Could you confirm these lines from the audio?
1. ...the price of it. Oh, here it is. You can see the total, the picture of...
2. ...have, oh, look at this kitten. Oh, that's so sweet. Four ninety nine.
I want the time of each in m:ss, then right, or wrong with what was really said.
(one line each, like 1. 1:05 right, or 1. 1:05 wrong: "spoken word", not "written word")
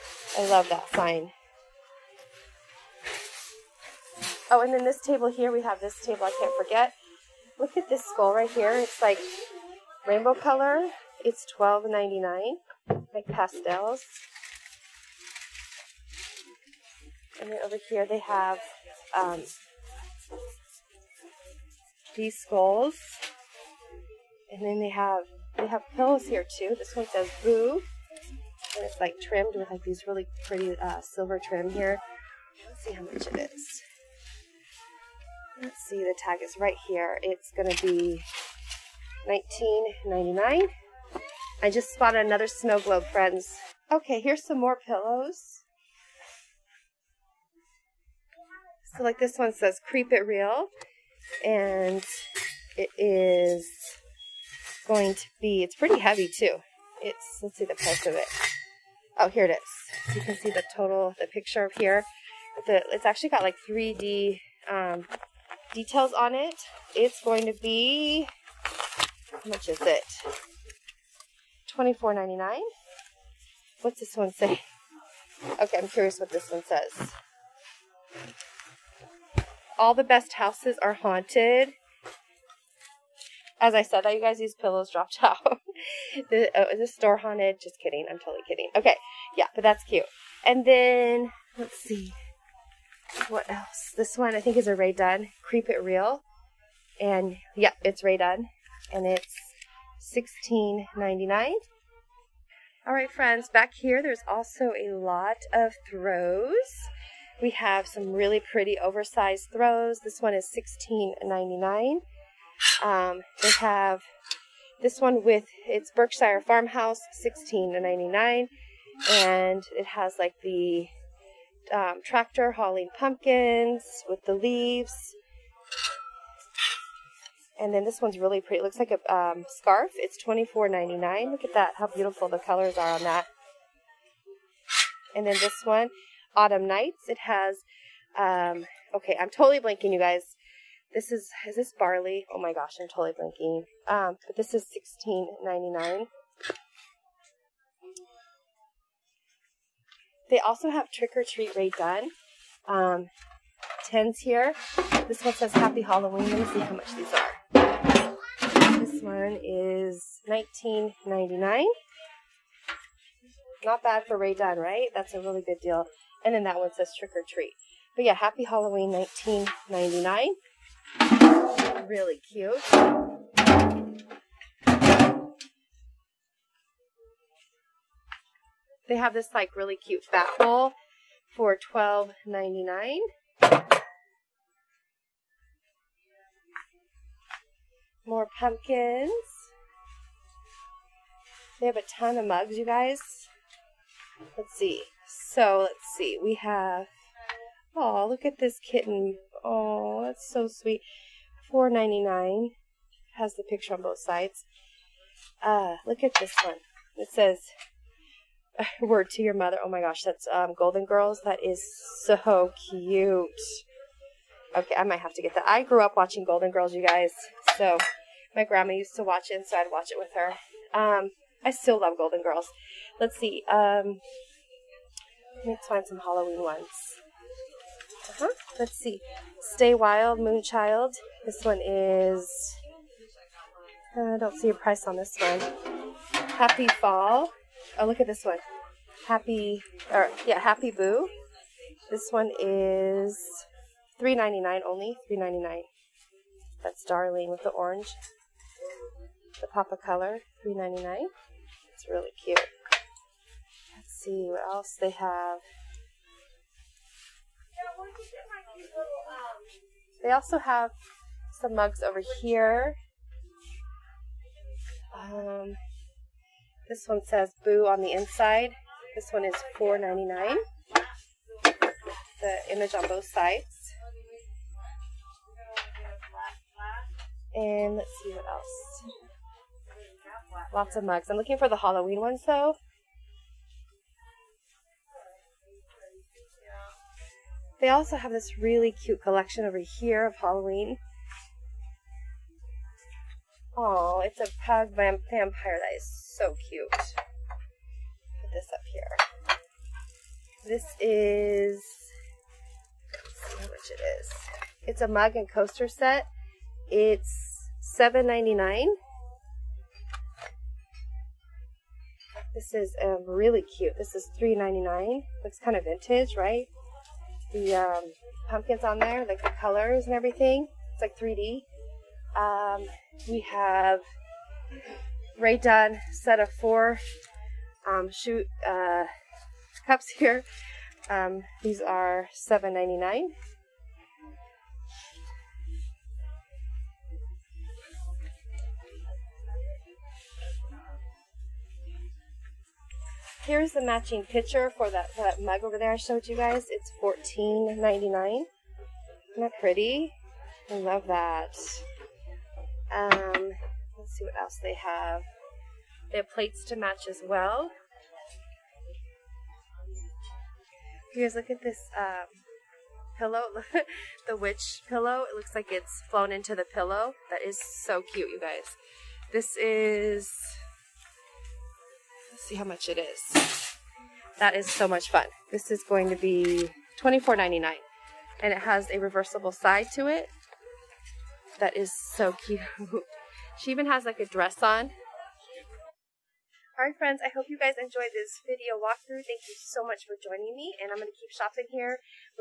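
1. 0:57 right
2. 3:16 right.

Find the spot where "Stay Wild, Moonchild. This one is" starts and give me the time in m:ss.
3:49.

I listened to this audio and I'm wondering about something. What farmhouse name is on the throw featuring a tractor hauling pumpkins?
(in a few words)
Berkshire Farmhouse.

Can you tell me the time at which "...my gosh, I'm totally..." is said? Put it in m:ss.
2:22.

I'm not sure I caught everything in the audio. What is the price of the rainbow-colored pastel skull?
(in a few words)
$12.99.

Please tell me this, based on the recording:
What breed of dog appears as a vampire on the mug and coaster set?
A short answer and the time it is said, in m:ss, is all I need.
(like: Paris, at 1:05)
Pug, at 4:54.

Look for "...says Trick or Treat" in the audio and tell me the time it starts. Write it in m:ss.
2:46.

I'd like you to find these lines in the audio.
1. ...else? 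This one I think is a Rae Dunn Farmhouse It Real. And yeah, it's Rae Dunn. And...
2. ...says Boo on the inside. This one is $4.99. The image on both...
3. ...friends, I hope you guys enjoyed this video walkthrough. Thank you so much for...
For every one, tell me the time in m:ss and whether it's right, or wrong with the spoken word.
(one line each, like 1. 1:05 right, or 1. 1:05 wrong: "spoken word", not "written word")
1. 1:33 wrong: "Creep", not "Farmhouse"
2. 4:27 right
3. 6:26 right.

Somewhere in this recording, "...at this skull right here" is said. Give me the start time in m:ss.
0:07.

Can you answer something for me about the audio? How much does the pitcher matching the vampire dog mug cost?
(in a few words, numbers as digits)
$14.99.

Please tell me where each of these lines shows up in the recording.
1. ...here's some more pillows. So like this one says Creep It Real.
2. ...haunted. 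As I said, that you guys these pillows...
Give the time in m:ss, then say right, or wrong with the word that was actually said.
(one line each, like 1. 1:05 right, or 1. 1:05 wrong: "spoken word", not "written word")
1. 0:44 right
2. 1:20 right.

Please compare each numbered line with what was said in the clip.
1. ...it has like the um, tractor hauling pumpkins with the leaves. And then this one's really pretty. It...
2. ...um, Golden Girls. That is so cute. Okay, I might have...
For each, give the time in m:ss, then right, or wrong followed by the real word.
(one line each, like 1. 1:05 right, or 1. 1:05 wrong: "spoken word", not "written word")
1. 1:59 right
2. 3:30 right.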